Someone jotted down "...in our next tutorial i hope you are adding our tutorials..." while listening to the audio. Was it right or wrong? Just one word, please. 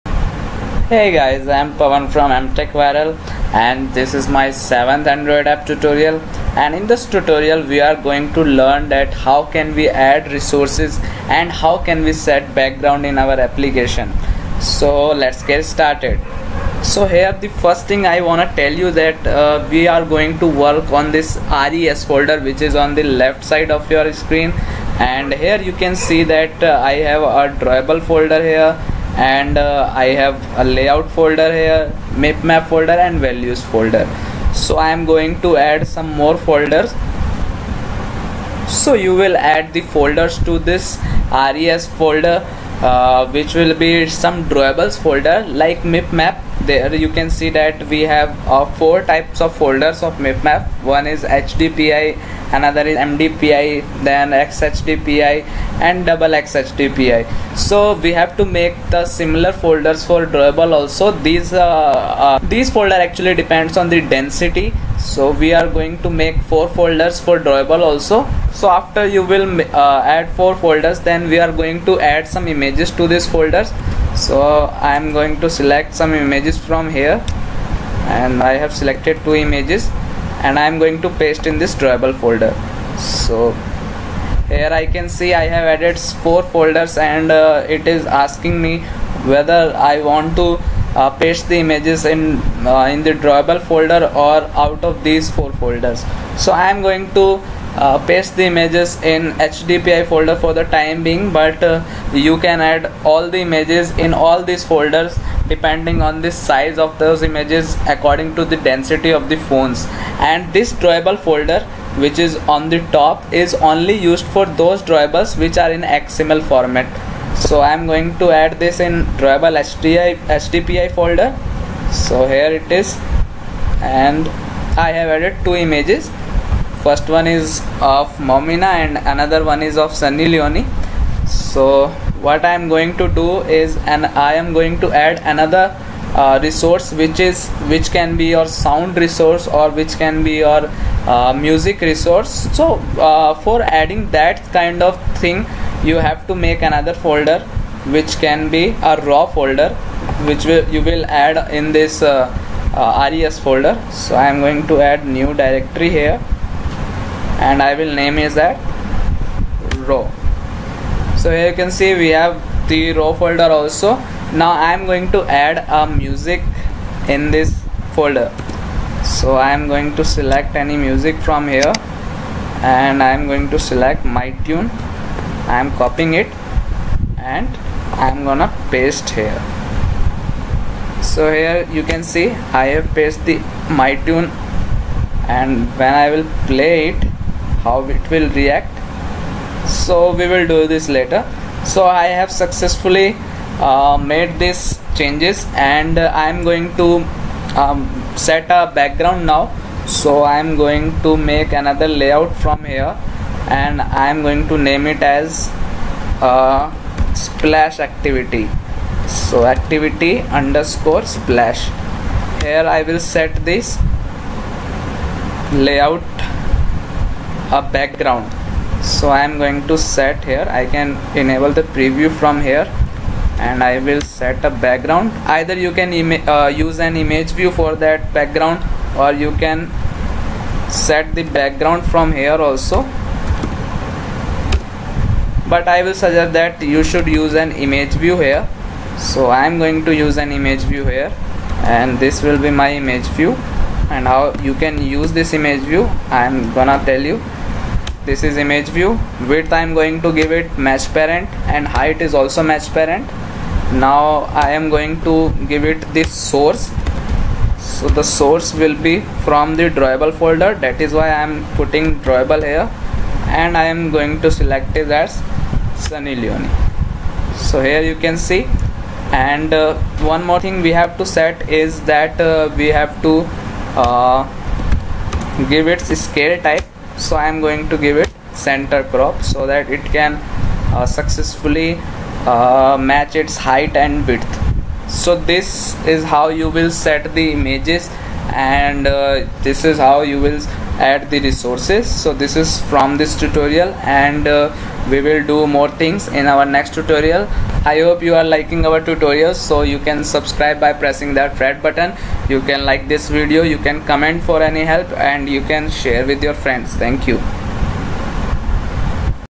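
wrong.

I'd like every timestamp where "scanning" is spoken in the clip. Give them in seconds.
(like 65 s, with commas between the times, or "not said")
not said.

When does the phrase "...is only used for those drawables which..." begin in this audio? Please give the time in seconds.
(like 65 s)
113 s.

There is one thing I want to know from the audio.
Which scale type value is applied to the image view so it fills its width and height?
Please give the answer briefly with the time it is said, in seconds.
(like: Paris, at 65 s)
center crop, at 278 s.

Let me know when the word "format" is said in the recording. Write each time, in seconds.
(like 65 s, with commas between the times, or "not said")
116 s.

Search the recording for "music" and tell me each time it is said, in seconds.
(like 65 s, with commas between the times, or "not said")
141 s, 165 s, 170 s.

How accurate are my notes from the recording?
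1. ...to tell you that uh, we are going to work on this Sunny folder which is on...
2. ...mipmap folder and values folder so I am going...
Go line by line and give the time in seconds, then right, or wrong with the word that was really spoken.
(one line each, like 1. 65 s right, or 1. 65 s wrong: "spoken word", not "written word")
1. 18 s wrong: "RES", not "Sunny"
2. 32 s right.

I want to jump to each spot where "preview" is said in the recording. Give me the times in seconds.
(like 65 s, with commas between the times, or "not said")
221 s.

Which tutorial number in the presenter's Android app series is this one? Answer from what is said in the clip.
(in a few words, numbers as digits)
7th.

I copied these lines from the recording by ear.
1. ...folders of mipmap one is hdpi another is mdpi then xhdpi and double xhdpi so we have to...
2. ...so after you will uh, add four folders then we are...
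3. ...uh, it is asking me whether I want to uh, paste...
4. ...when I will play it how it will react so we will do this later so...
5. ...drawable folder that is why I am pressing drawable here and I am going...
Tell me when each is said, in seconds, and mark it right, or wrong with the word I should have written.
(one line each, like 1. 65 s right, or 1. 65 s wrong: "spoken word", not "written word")
1. 49 s right
2. 68 s right
3. 87 s right
4. 185 s right
5. 259 s wrong: "putting", not "pressing".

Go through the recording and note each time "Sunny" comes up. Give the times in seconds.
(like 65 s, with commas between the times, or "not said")
129 s, 265 s.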